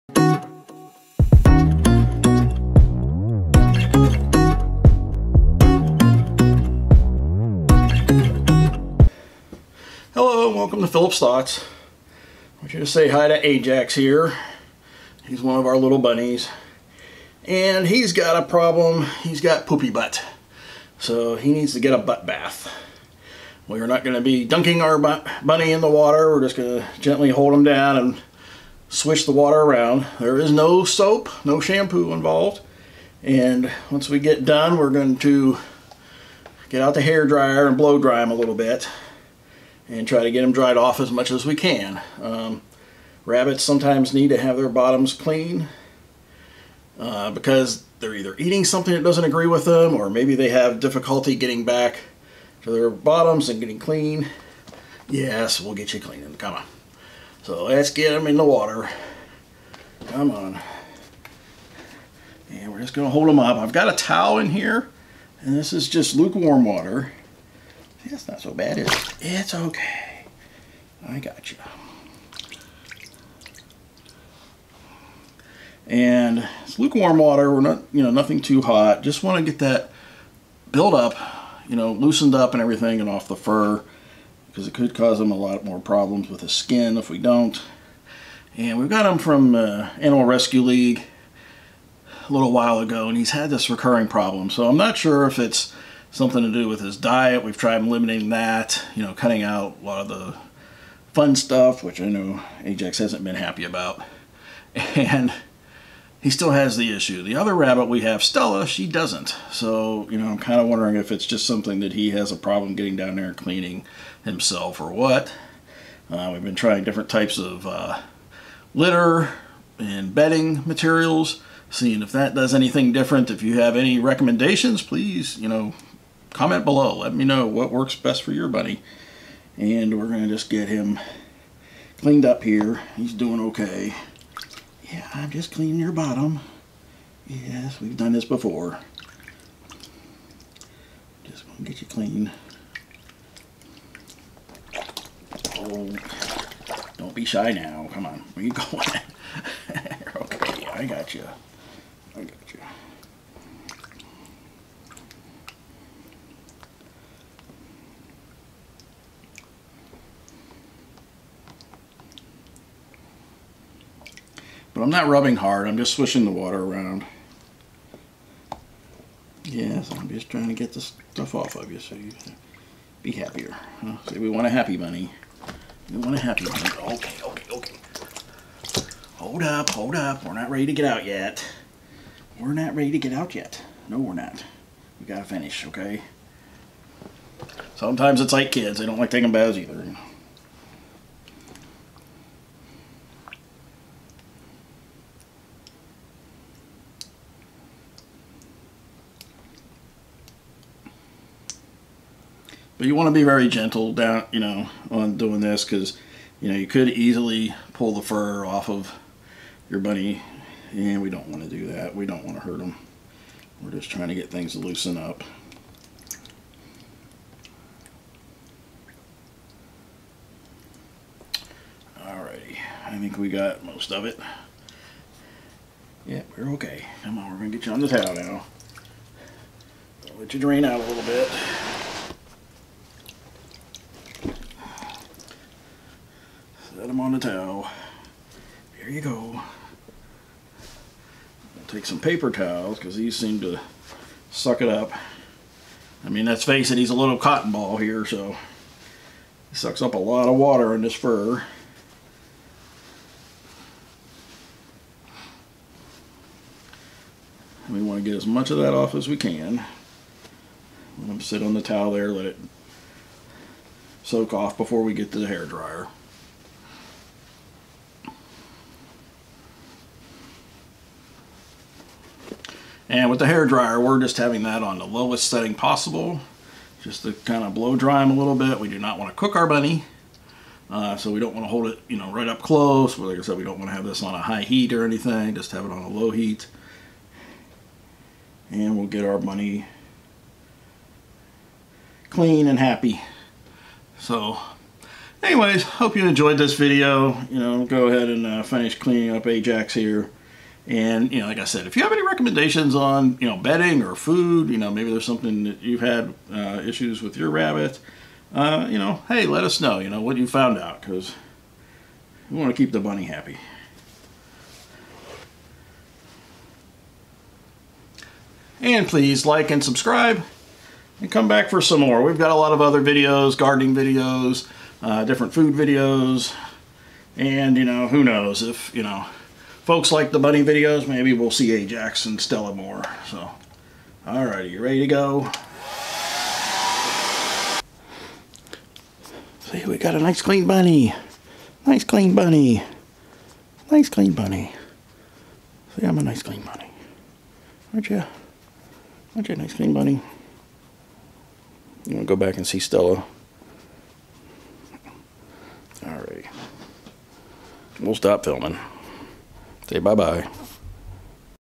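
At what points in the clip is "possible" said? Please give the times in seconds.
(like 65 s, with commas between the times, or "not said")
275 s.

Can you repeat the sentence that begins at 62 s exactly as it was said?
And we're just going to hold them up.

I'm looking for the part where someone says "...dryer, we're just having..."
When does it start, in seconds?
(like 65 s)
273 s.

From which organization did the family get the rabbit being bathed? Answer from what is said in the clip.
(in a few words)
Animal Rescue League.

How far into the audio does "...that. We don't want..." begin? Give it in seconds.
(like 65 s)
211 s.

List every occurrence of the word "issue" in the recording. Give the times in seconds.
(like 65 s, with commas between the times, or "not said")
106 s, 306 s.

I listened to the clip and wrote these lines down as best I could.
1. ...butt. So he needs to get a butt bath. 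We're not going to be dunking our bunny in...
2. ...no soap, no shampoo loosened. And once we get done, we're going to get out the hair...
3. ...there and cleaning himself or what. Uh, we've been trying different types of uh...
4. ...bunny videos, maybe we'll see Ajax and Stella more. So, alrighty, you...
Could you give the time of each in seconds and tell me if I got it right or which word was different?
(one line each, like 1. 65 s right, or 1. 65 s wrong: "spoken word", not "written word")
1. 19 s right
2. 30 s wrong: "involved", not "loosened"
3. 113 s right
4. 330 s right.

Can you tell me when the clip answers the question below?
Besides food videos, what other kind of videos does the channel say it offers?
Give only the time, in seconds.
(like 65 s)
323 s.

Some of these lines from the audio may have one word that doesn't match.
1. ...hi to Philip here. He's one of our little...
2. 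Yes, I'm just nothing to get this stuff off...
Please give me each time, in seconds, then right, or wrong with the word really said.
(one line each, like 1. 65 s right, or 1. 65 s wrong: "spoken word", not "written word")
1. 13 s wrong: "Ajax", not "Philip"
2. 169 s wrong: "trying", not "nothing".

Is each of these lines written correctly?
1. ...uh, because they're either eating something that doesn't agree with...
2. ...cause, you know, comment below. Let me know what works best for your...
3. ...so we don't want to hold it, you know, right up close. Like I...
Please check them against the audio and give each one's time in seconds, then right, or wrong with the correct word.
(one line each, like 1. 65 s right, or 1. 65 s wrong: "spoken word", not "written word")
1. 46 s right
2. 124 s wrong: "please", not "cause"
3. 280 s right.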